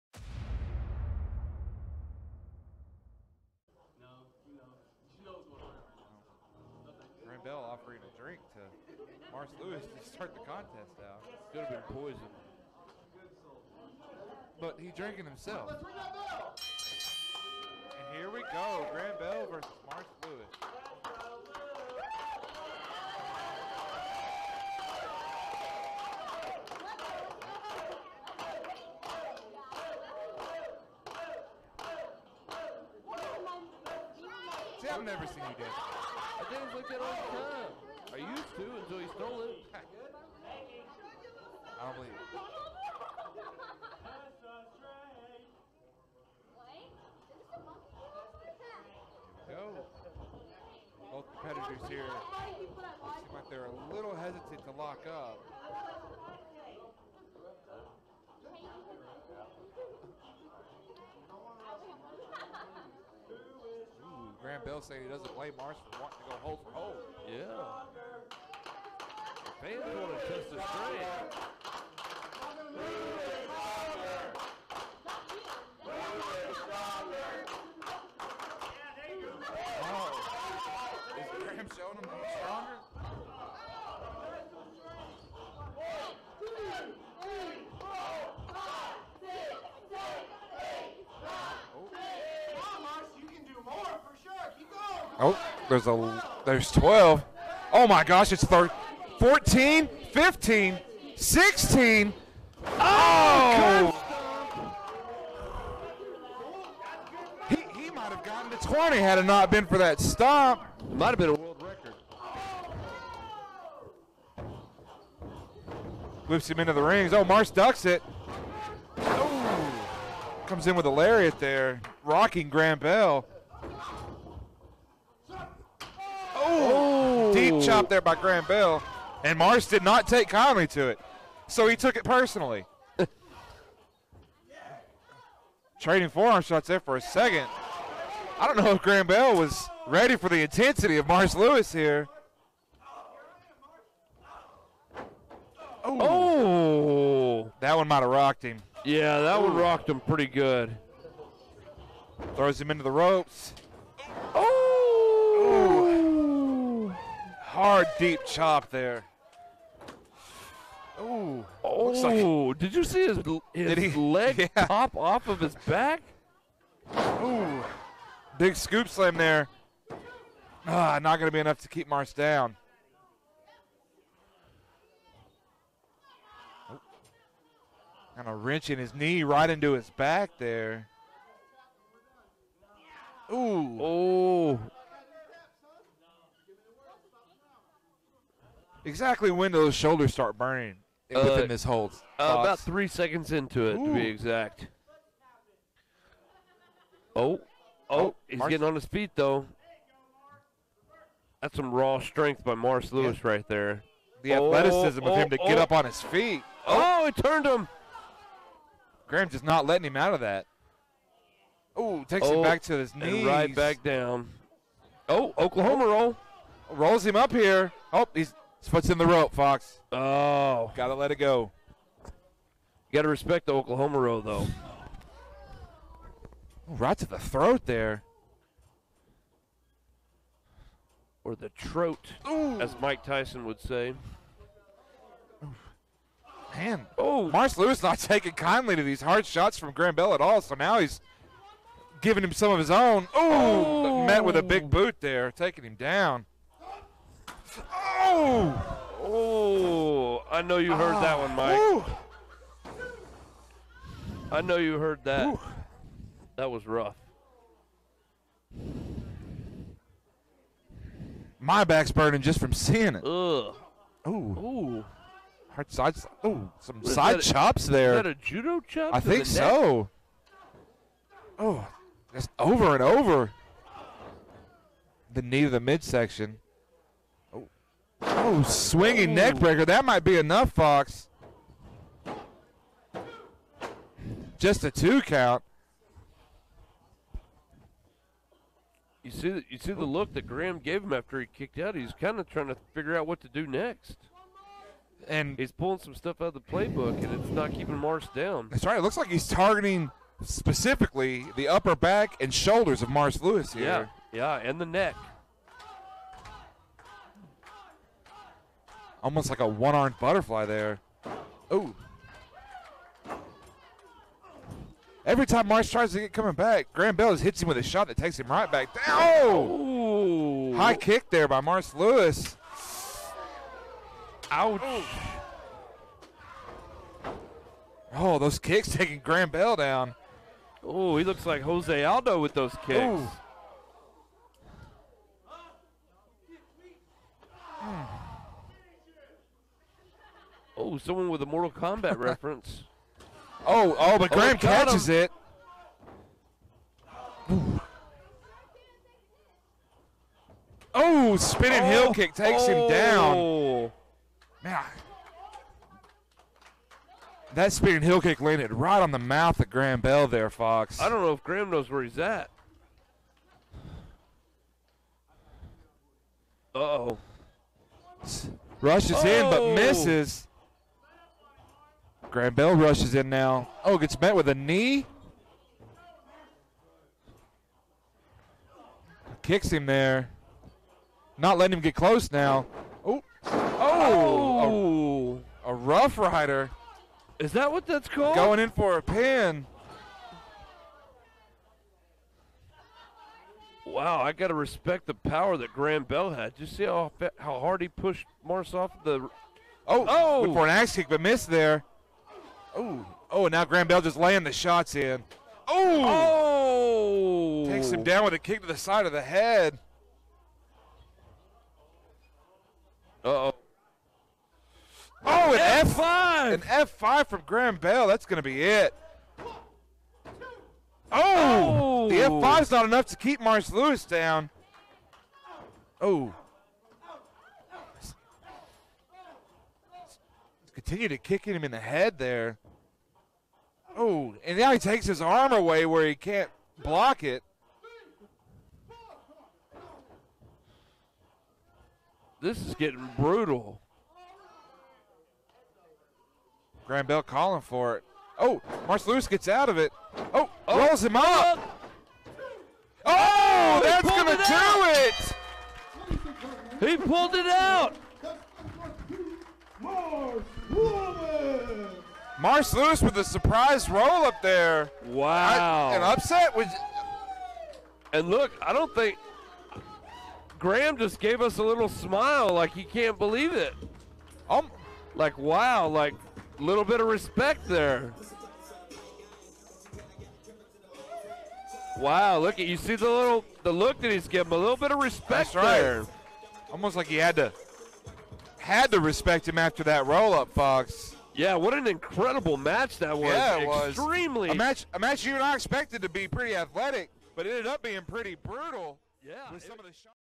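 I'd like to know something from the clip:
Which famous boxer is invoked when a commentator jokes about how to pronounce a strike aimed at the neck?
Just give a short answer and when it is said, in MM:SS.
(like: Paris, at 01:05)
Mike Tyson, at 03:52.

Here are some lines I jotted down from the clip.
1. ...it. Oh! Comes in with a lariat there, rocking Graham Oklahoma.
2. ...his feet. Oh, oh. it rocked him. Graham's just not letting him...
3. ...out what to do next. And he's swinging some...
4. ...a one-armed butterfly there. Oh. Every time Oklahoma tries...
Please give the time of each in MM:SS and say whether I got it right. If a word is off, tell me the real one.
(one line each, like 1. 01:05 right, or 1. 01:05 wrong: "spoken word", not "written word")
1. 01:57 wrong: "Bell", not "Oklahoma"
2. 03:25 wrong: "turned", not "rocked"
3. 04:52 wrong: "pulling", not "swinging"
4. 05:09 wrong: "Marce", not "Oklahoma".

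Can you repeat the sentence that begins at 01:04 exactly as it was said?
Graham Bell saying he doesn't blame Marce for wanting to go hole for hole.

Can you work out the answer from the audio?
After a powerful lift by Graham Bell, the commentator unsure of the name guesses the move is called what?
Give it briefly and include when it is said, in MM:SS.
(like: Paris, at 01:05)
Rough rider, at 06:25.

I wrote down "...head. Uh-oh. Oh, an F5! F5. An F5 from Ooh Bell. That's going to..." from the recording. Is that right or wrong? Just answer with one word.
wrong.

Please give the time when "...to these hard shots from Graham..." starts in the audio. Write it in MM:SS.
03:58.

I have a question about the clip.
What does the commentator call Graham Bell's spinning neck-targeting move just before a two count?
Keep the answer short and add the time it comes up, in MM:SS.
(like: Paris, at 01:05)
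Swinging neck breaker, at 04:38.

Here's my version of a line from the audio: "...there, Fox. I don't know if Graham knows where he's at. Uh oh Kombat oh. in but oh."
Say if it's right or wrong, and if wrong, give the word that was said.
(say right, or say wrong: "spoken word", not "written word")
wrong: "Rushes", not "Kombat".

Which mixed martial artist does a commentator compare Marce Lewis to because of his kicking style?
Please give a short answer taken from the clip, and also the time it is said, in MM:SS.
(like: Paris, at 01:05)
Jose Aldo, at 05:31.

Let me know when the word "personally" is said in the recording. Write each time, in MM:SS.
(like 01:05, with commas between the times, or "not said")
02:12.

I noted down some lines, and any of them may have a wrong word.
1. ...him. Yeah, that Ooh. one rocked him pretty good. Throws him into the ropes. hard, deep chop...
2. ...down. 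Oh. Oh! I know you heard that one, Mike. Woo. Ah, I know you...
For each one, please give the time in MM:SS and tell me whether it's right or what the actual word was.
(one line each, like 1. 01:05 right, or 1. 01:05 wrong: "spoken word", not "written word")
1. 02:28 right
2. 04:05 right.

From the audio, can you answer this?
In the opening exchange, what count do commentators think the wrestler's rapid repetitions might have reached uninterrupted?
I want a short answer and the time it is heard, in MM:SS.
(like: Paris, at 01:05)
20, at 01:48.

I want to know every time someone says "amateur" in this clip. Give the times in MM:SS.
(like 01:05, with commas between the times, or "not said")
not said.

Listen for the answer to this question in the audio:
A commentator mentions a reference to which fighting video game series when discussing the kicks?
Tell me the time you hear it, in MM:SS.
05:41.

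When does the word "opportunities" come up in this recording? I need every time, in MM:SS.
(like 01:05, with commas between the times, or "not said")
not said.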